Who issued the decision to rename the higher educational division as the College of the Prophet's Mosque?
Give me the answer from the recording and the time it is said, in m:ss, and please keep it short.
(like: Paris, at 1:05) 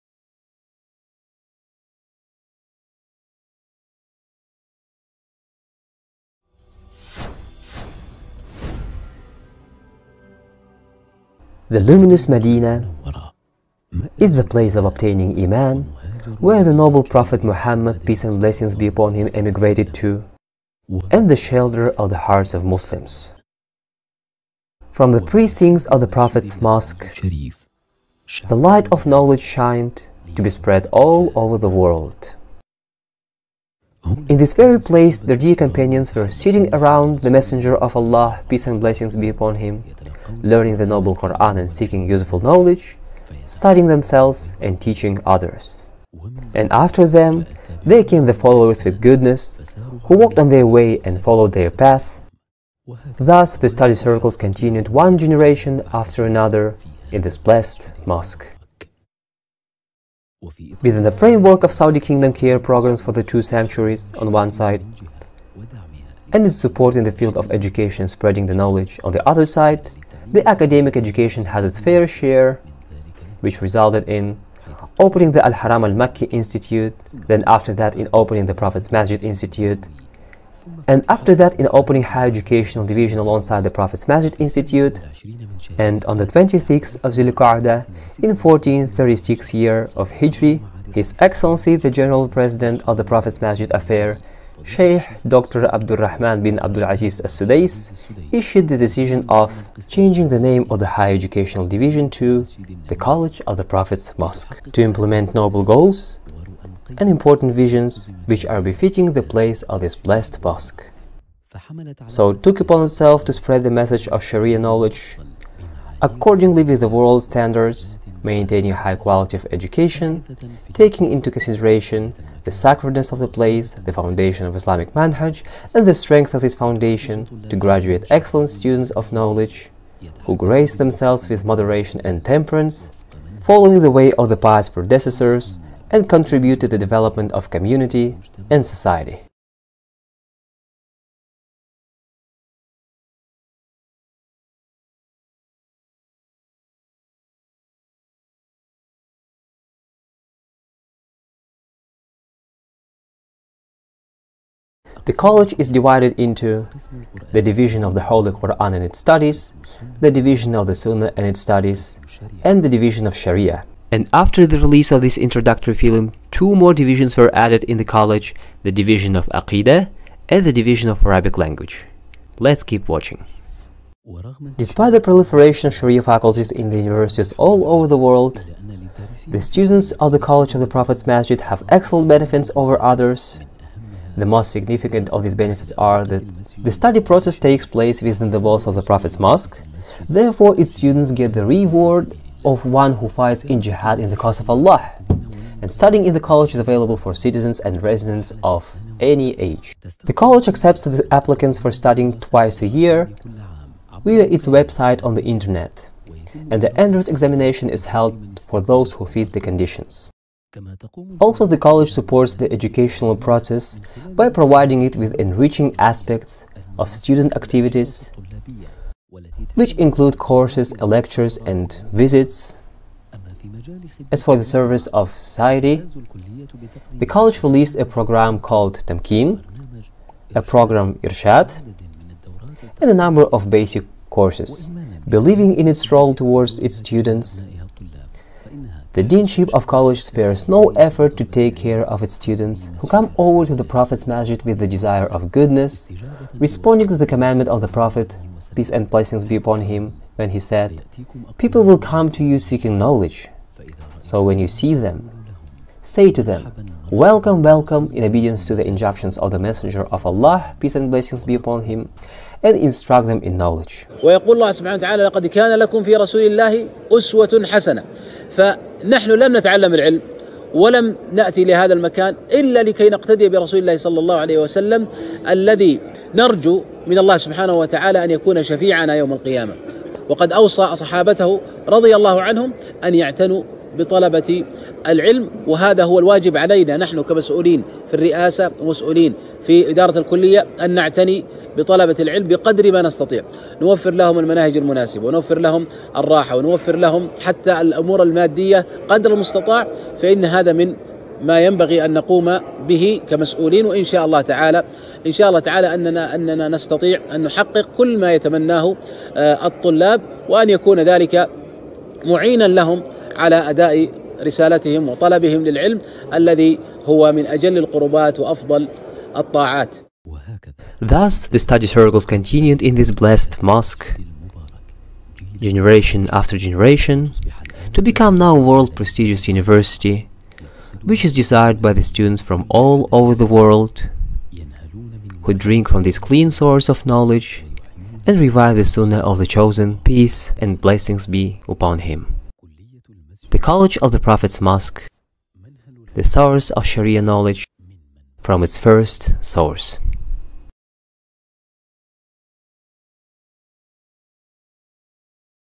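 Abdul Rahman bin Abdul Aziz al Sudais, at 1:35.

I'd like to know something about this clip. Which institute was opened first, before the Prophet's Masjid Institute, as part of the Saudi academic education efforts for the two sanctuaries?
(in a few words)
Al-Haram Al-Makki Institute.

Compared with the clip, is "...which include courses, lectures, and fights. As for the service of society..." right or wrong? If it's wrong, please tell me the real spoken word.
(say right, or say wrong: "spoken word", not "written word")
wrong: "visits", not "fights".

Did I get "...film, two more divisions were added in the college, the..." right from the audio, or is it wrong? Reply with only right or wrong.
right.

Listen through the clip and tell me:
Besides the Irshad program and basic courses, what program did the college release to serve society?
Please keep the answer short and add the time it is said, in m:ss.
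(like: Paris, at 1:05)
Tamkin, at 3:48.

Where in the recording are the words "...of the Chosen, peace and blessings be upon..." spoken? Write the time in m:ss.
5:39.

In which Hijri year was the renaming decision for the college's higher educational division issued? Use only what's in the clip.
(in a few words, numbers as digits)
1436.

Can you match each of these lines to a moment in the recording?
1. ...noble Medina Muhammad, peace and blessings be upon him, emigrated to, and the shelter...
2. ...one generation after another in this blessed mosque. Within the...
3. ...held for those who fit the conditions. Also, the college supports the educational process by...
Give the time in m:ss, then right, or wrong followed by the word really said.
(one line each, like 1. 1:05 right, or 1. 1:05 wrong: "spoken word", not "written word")
1. 0:16 wrong: "Prophet", not "Medina"
2. 0:54 right
3. 3:27 right.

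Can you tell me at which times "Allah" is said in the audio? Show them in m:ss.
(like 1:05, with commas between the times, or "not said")
0:37, 3:14, 4:20.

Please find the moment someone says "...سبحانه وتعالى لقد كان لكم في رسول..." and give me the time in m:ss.
4:24.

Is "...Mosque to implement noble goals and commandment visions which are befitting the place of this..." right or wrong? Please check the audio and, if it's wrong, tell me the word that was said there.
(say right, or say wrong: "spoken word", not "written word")
wrong: "important", not "commandment".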